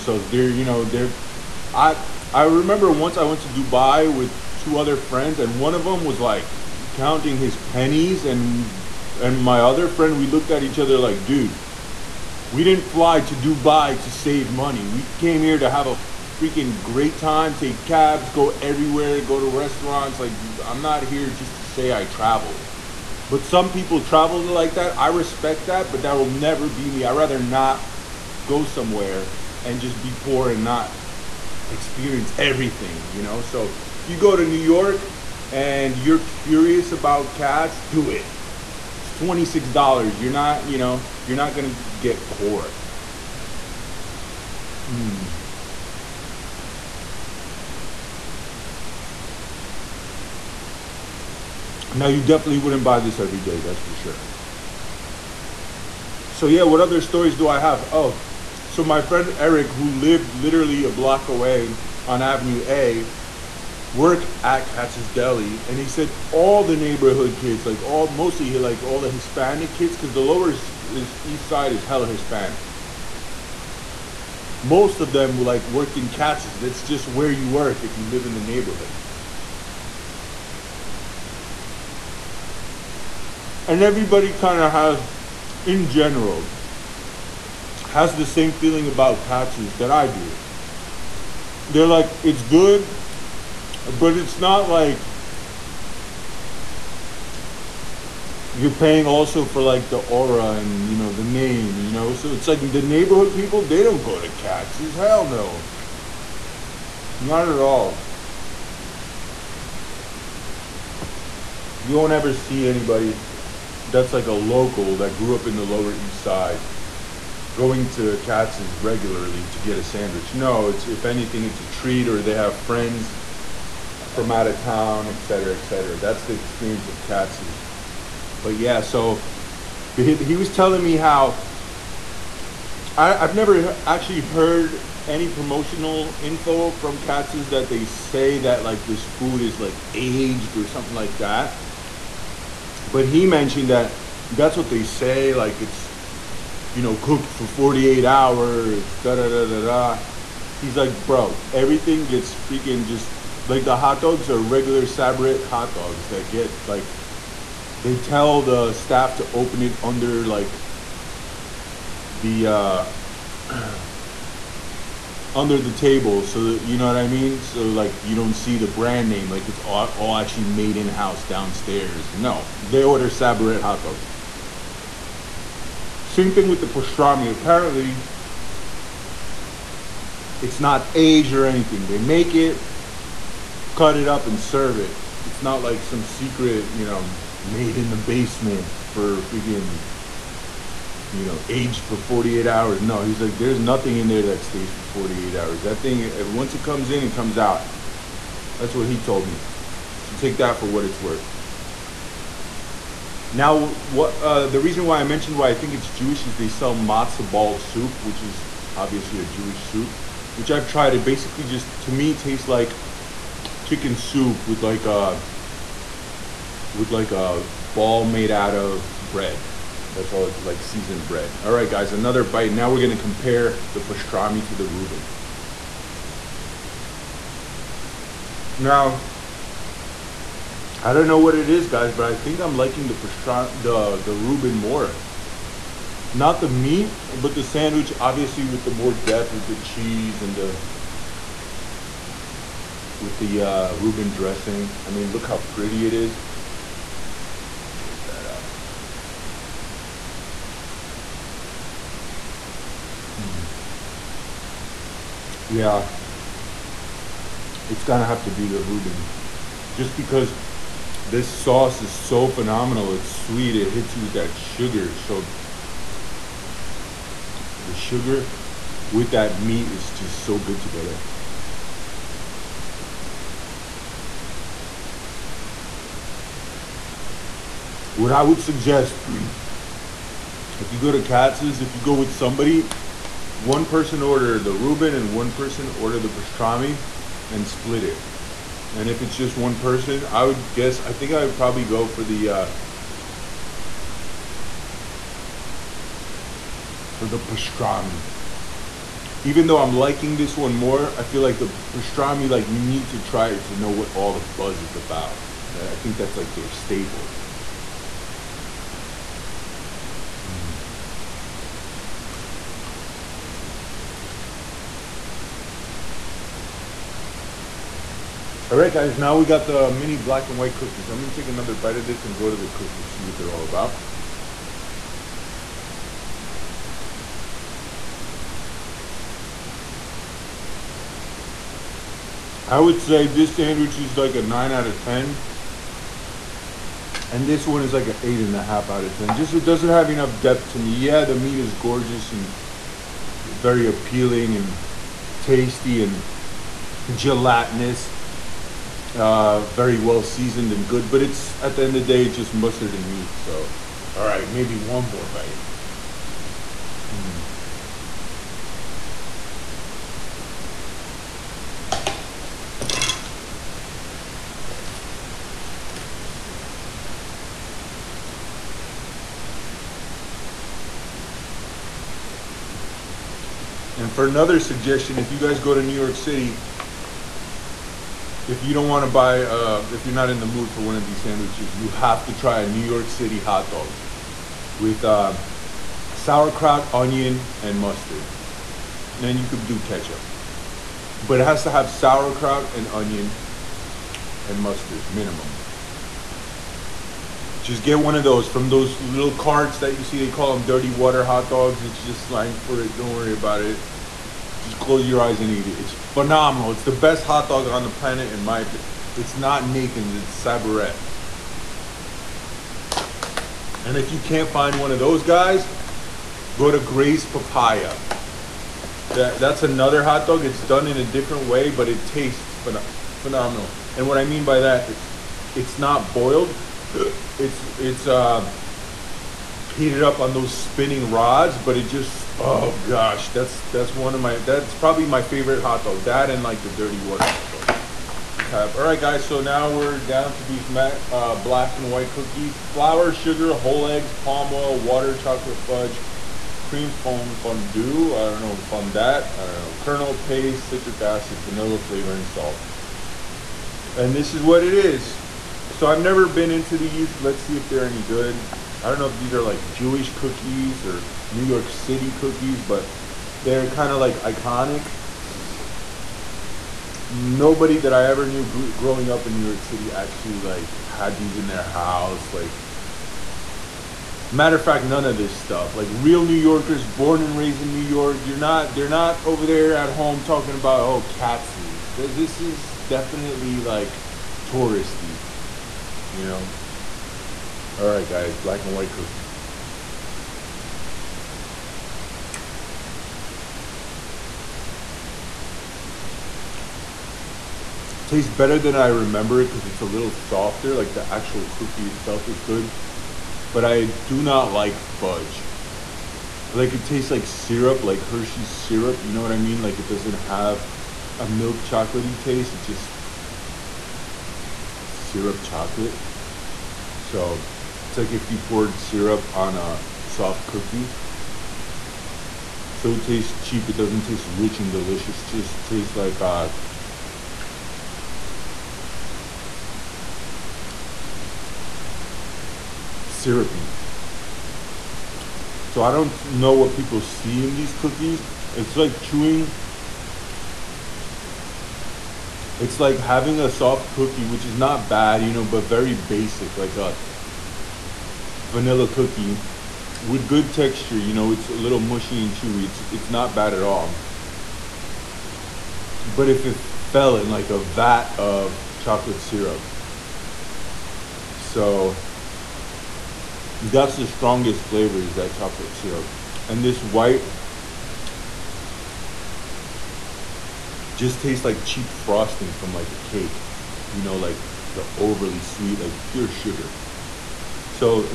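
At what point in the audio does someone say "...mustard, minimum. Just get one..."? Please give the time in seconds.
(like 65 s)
394 s.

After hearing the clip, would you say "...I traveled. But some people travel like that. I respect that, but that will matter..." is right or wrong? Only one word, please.
wrong.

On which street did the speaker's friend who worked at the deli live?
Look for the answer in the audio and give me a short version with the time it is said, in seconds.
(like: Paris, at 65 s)
Avenue A, at 62 s.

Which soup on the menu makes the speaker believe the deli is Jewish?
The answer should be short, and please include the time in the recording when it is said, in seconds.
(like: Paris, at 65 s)
Matzah ball soup, at 206 s.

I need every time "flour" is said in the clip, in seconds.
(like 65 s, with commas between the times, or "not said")
442 s.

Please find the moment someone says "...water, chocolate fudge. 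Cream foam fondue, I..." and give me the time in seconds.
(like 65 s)
444 s.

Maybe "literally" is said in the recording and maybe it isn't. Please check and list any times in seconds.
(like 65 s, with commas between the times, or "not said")
60 s.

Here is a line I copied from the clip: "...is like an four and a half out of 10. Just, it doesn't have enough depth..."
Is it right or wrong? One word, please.
wrong.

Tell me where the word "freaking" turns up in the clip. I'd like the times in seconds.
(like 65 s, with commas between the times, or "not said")
16 s, 152 s, 189 s.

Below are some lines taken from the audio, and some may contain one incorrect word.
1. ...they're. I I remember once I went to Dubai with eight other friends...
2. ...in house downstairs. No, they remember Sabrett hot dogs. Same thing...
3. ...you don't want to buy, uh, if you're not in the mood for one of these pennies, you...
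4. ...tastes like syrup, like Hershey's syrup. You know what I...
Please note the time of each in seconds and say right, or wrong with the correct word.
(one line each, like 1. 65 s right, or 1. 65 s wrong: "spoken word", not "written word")
1. 0 s wrong: "two", not "eight"
2. 170 s wrong: "order", not "remember"
3. 378 s wrong: "sandwiches", not "pennies"
4. 506 s right.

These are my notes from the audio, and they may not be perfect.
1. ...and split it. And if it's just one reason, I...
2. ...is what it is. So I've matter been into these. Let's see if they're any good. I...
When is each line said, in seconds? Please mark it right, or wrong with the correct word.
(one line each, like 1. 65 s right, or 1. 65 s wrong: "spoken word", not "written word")
1. 287 s wrong: "person", not "reason"
2. 454 s wrong: "never", not "matter".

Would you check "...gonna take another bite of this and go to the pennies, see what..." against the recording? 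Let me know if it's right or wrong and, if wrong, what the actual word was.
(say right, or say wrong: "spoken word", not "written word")
wrong: "cookies", not "pennies".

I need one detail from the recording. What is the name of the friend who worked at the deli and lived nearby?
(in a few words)
Eric.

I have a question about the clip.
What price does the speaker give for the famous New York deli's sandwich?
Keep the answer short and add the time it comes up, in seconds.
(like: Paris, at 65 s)
$26, at 39 s.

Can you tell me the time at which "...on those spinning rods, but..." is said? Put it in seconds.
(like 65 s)
429 s.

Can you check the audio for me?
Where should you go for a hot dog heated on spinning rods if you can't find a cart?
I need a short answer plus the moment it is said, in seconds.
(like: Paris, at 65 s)
Gray's Papaya, at 416 s.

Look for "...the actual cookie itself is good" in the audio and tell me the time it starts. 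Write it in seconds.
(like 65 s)
500 s.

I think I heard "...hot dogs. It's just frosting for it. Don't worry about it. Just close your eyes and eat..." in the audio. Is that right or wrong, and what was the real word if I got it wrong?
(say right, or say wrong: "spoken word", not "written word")
wrong: "slang", not "frosting".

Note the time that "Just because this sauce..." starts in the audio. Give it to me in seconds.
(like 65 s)
259 s.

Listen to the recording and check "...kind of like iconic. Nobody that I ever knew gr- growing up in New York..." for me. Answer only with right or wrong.
right.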